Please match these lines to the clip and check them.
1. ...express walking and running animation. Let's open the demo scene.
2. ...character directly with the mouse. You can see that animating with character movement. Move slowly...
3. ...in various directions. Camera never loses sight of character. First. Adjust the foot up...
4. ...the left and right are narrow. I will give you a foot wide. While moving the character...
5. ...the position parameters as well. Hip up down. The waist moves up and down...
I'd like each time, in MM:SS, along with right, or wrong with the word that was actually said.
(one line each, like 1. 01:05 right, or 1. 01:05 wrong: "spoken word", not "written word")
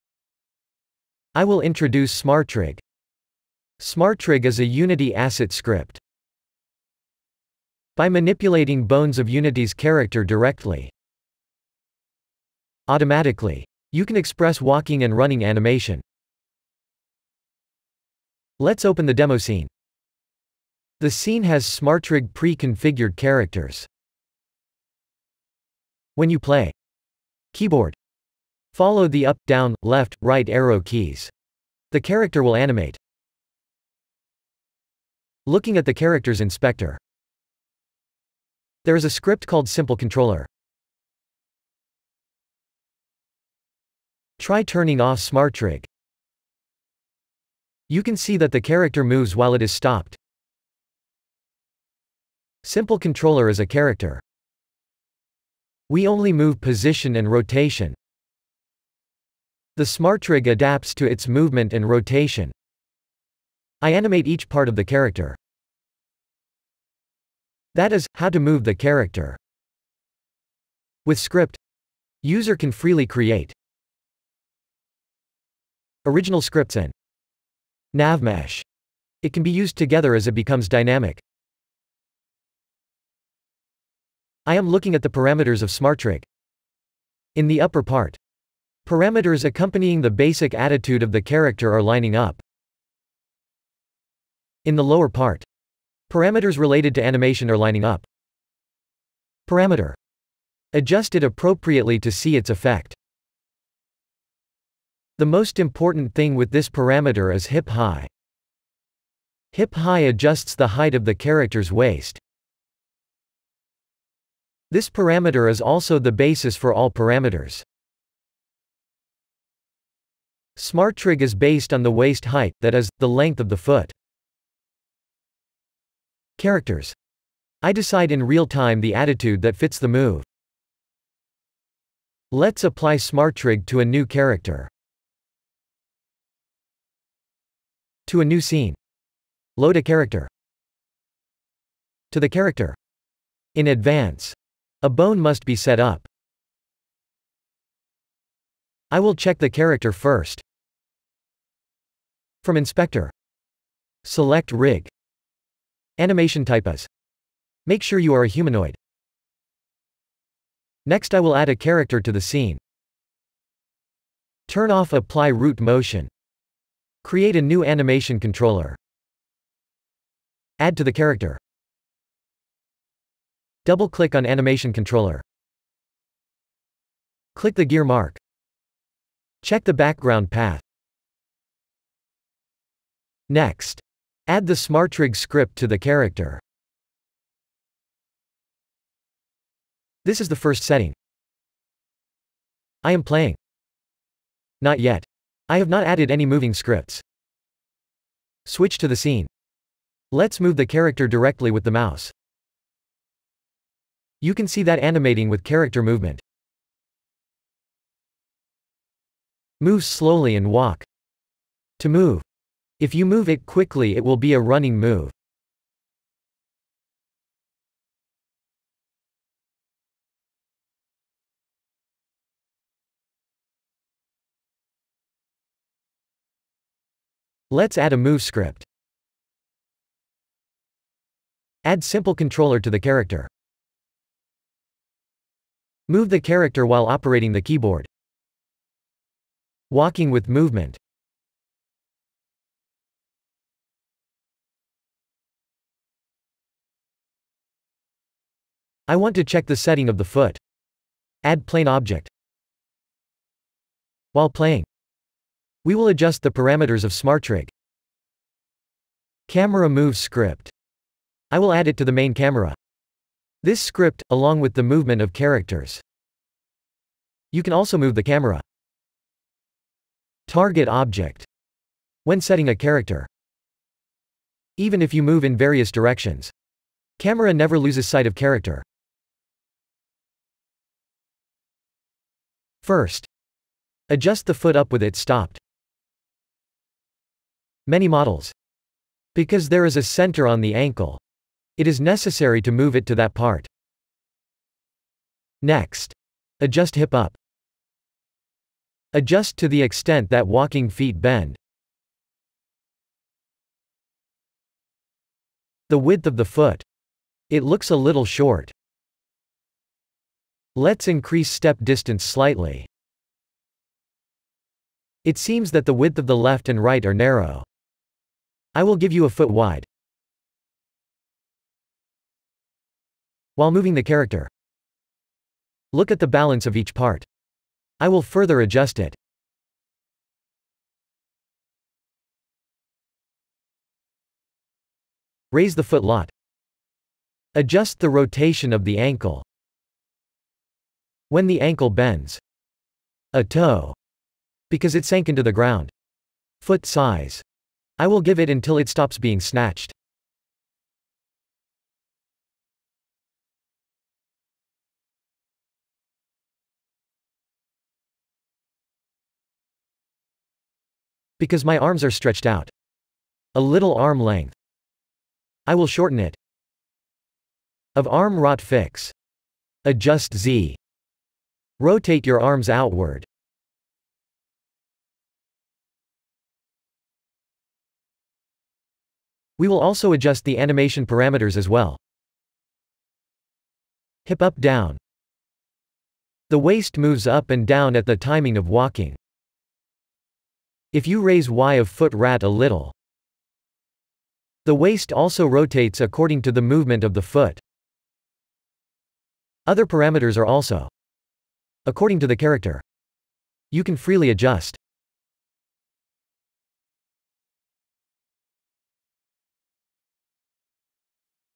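1. 00:14 right
2. 03:20 right
3. 04:35 right
4. 05:16 right
5. 06:20 wrong: "animation", not "position".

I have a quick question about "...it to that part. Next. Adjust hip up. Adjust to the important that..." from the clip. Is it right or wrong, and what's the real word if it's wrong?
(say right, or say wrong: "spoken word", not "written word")
wrong: "extent", not "important".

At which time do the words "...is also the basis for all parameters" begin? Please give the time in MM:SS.
01:55.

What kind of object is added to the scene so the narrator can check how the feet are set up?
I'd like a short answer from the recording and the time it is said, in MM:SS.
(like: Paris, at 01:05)
Plane object, at 04:11.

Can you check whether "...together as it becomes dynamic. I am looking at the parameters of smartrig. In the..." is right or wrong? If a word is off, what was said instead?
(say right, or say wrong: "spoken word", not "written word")
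right.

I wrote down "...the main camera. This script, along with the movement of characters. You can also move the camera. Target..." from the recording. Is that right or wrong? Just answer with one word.
right.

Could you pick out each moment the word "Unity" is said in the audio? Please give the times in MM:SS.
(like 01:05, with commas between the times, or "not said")
00:04, 00:09.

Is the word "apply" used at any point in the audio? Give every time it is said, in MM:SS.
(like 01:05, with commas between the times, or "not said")
02:12, 02:44.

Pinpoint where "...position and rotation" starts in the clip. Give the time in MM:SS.
00:56.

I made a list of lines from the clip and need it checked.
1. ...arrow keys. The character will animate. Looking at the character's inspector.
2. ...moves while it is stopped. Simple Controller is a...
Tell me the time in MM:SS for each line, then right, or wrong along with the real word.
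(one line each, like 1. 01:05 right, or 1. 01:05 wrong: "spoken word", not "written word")
1. 00:30 right
2. 00:49 right.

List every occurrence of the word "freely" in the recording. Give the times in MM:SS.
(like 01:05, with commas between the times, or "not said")
01:12, 06:43.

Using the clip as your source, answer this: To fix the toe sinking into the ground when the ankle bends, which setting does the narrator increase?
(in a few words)
Foot size.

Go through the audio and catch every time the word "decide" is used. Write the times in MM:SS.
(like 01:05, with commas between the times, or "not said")
02:07.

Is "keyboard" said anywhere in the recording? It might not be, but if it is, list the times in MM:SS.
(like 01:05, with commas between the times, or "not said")
00:27, 03:57.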